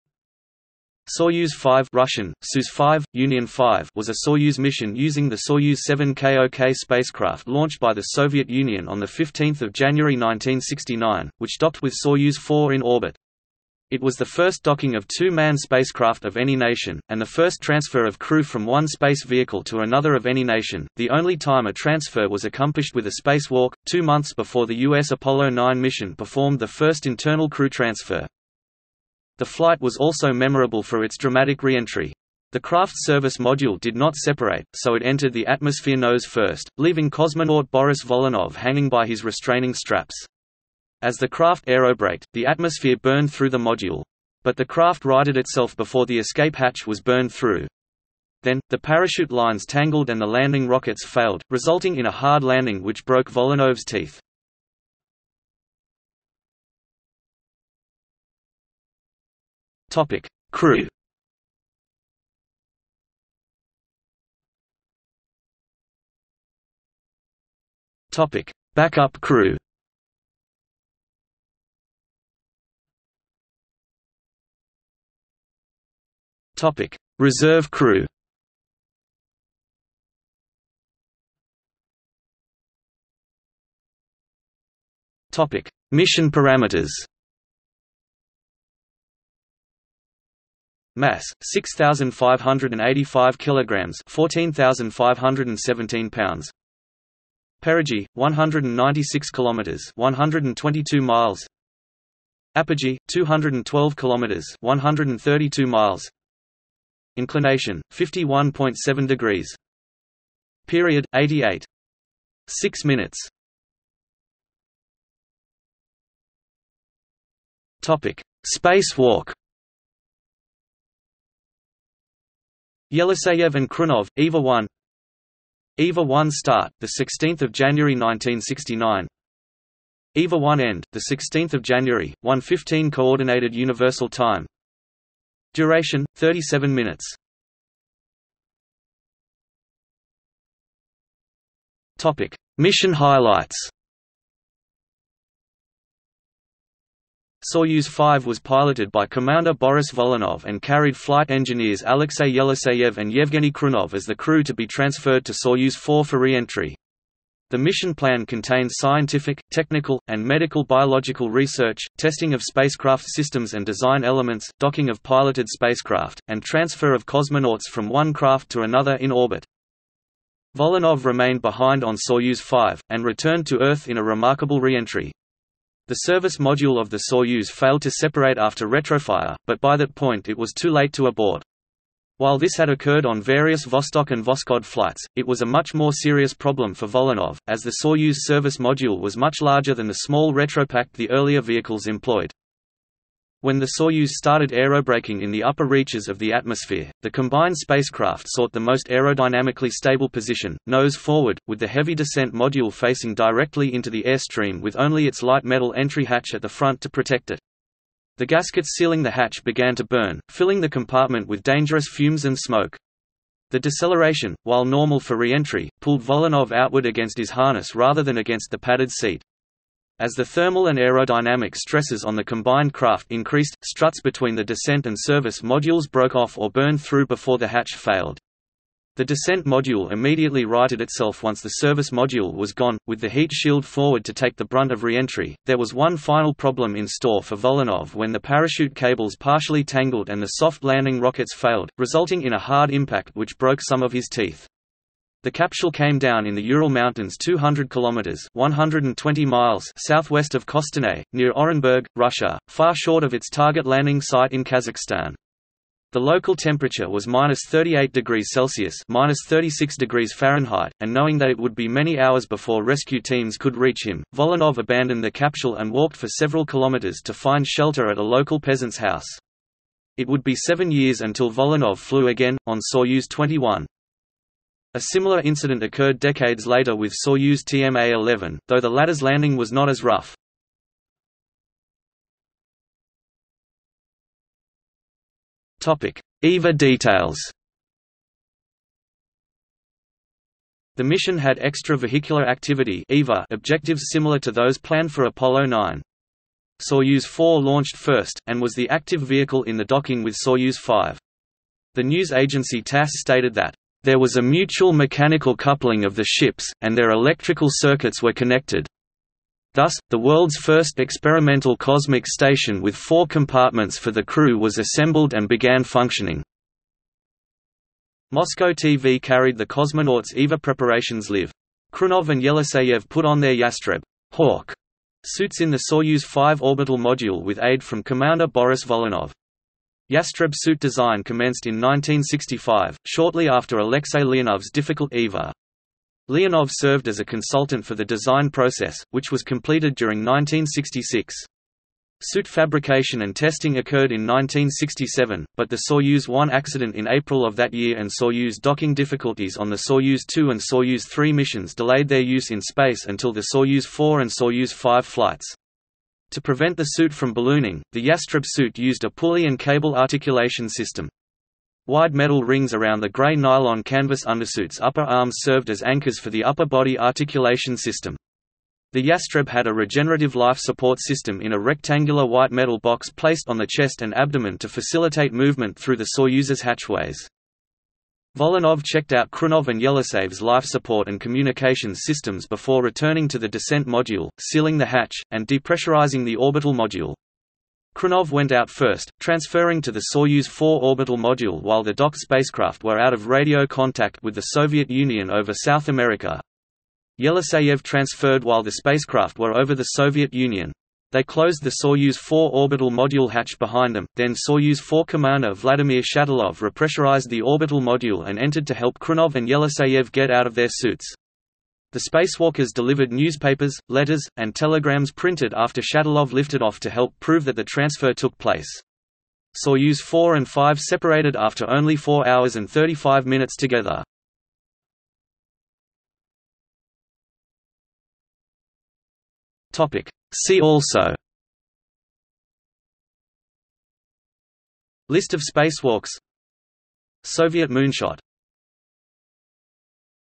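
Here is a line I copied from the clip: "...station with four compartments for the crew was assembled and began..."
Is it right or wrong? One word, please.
right.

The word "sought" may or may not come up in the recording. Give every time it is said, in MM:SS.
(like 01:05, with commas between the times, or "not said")
03:18.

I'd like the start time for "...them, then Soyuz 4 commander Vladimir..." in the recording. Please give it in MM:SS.
06:43.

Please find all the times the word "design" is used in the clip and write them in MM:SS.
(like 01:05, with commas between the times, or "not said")
02:43, 05:30, 05:37.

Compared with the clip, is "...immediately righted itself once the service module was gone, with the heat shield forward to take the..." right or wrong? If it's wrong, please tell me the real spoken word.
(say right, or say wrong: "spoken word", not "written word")
right.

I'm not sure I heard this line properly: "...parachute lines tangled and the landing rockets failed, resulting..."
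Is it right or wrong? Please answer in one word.
right.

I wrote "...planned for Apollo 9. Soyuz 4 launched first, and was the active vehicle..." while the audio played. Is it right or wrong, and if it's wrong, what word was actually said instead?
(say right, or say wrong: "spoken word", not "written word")
right.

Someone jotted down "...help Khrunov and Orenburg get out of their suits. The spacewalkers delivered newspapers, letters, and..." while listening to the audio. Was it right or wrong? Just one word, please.
wrong.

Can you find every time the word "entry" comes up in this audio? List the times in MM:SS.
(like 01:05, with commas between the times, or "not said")
00:31, 02:36, 02:54, 03:25, 03:35, 03:54.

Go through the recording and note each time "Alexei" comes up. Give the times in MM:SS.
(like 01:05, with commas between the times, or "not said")
02:31, 05:33.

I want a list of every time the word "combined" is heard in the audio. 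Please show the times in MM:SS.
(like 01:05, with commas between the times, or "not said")
03:17, 03:42.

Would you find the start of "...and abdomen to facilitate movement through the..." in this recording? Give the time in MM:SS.
06:13.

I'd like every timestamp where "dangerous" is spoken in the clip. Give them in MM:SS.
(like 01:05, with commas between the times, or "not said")
03:31.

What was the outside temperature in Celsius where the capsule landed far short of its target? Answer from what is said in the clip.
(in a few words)
-38 degrees Celsius.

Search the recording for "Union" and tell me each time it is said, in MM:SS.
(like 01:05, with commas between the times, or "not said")
00:03, 00:08, 06:34, 06:40.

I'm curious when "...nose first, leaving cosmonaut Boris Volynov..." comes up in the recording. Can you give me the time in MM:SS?
00:35.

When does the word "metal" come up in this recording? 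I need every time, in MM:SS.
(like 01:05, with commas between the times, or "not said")
03:25, 06:01, 06:12.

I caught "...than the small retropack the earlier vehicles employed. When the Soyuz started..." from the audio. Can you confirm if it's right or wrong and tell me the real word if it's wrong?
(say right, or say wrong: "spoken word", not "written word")
right.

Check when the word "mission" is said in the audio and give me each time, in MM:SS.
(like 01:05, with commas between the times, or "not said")
00:04, 00:25, 01:25, 02:22, 02:37, 04:50, 05:51.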